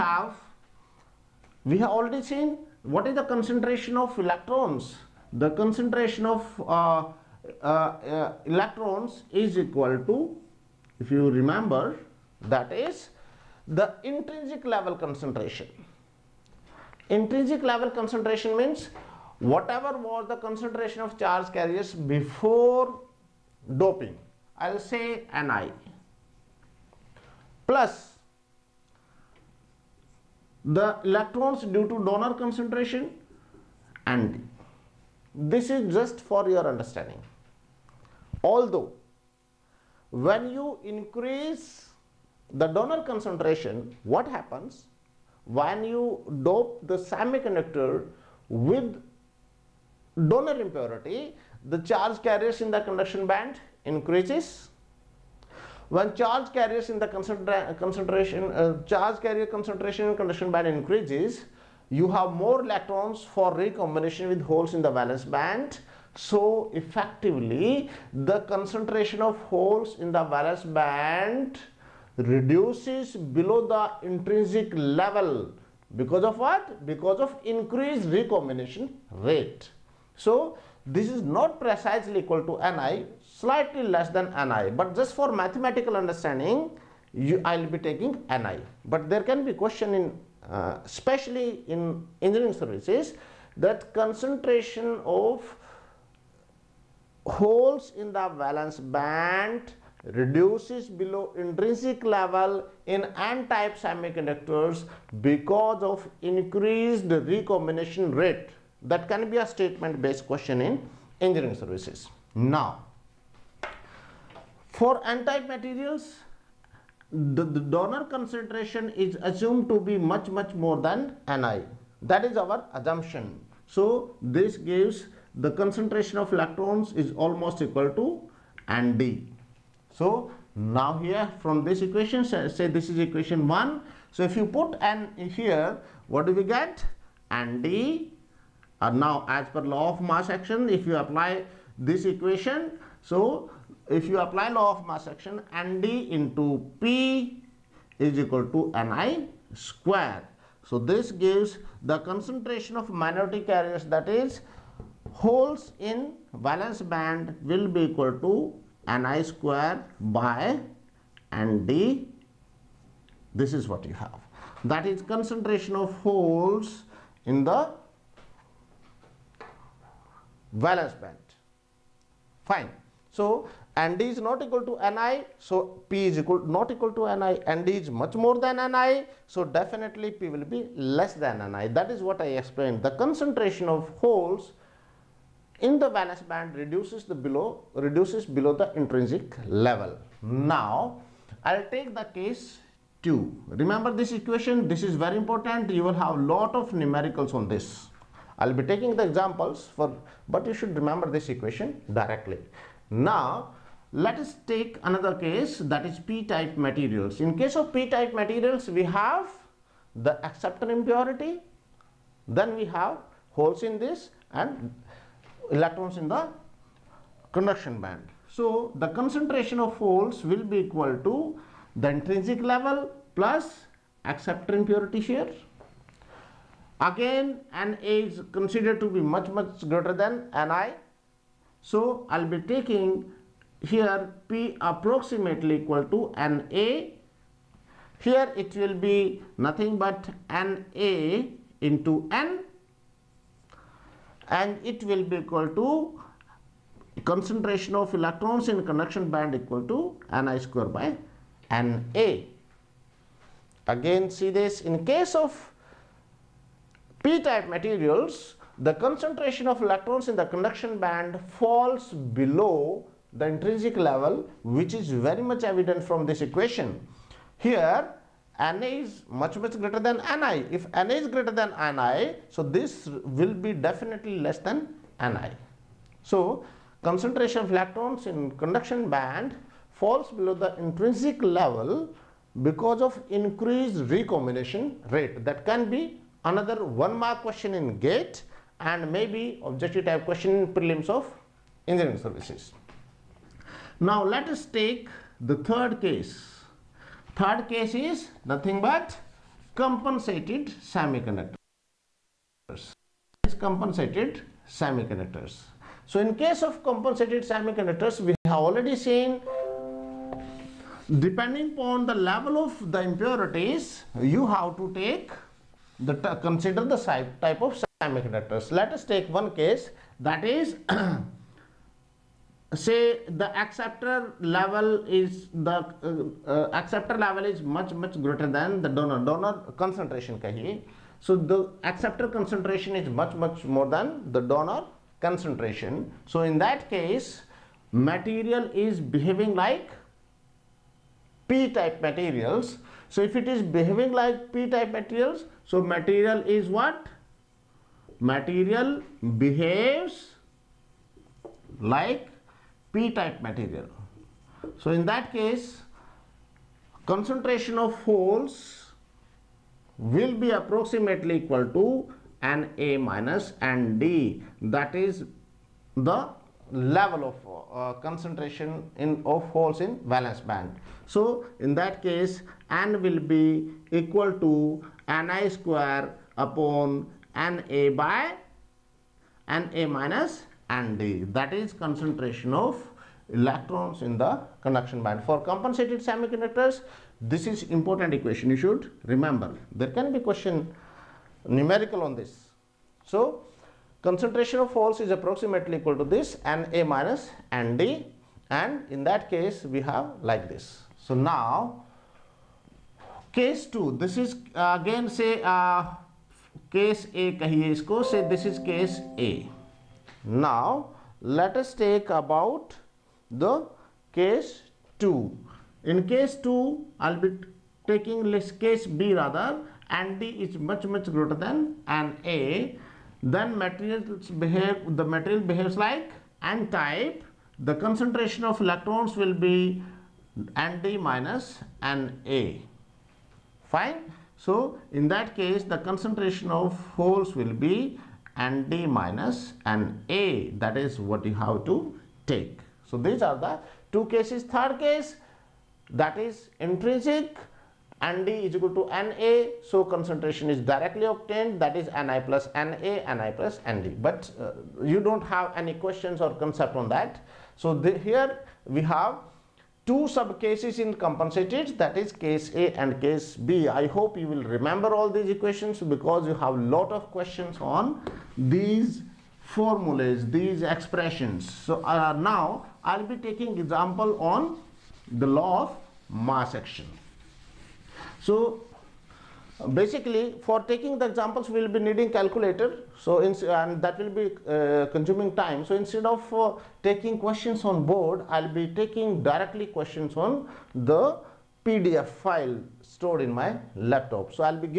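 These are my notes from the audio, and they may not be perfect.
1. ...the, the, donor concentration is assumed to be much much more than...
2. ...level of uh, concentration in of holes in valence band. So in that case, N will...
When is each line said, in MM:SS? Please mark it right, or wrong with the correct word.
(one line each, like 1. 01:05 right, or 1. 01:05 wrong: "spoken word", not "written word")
1. 01:57 right
2. 06:06 right.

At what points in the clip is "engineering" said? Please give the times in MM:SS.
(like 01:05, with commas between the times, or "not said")
01:32, 01:51, 04:51.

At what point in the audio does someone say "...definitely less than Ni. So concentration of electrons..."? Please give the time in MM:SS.
04:33.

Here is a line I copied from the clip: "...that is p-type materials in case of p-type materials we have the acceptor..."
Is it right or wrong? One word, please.
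right.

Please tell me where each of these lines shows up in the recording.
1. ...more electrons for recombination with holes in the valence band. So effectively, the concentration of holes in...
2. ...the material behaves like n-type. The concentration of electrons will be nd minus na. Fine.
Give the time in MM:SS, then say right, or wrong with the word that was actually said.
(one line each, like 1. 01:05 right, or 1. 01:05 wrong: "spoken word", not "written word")
1. 01:02 right
2. 07:04 right.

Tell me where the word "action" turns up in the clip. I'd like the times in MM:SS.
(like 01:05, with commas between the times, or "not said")
02:20, 02:25, 07:56.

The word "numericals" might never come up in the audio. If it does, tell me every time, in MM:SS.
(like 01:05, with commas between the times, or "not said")
03:16, 06:31.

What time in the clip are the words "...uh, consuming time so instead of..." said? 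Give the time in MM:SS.
08:04.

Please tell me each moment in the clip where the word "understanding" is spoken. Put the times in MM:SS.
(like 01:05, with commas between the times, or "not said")
00:36, 01:25.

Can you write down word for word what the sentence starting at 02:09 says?
So now here from this equation, say this is equation 1.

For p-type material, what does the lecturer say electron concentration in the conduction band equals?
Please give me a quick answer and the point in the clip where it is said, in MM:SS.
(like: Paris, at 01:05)
ni²/Na, at 04:10.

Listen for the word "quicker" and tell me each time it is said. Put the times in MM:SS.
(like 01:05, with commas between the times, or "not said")
not said.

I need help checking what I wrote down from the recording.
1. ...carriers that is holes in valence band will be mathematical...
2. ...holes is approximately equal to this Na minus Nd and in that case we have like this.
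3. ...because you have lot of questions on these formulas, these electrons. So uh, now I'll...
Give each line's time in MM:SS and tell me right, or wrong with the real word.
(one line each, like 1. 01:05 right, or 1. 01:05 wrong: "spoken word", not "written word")
1. 02:33 wrong: "equal", not "mathematical"
2. 06:34 right
3. 07:45 wrong: "expressions", not "electrons".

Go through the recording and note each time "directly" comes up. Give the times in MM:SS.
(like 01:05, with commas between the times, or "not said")
03:21, 07:30, 08:09.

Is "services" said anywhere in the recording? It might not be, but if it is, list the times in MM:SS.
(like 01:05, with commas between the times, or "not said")
01:32, 01:51, 04:51.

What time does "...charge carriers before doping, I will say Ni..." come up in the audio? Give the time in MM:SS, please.
00:21.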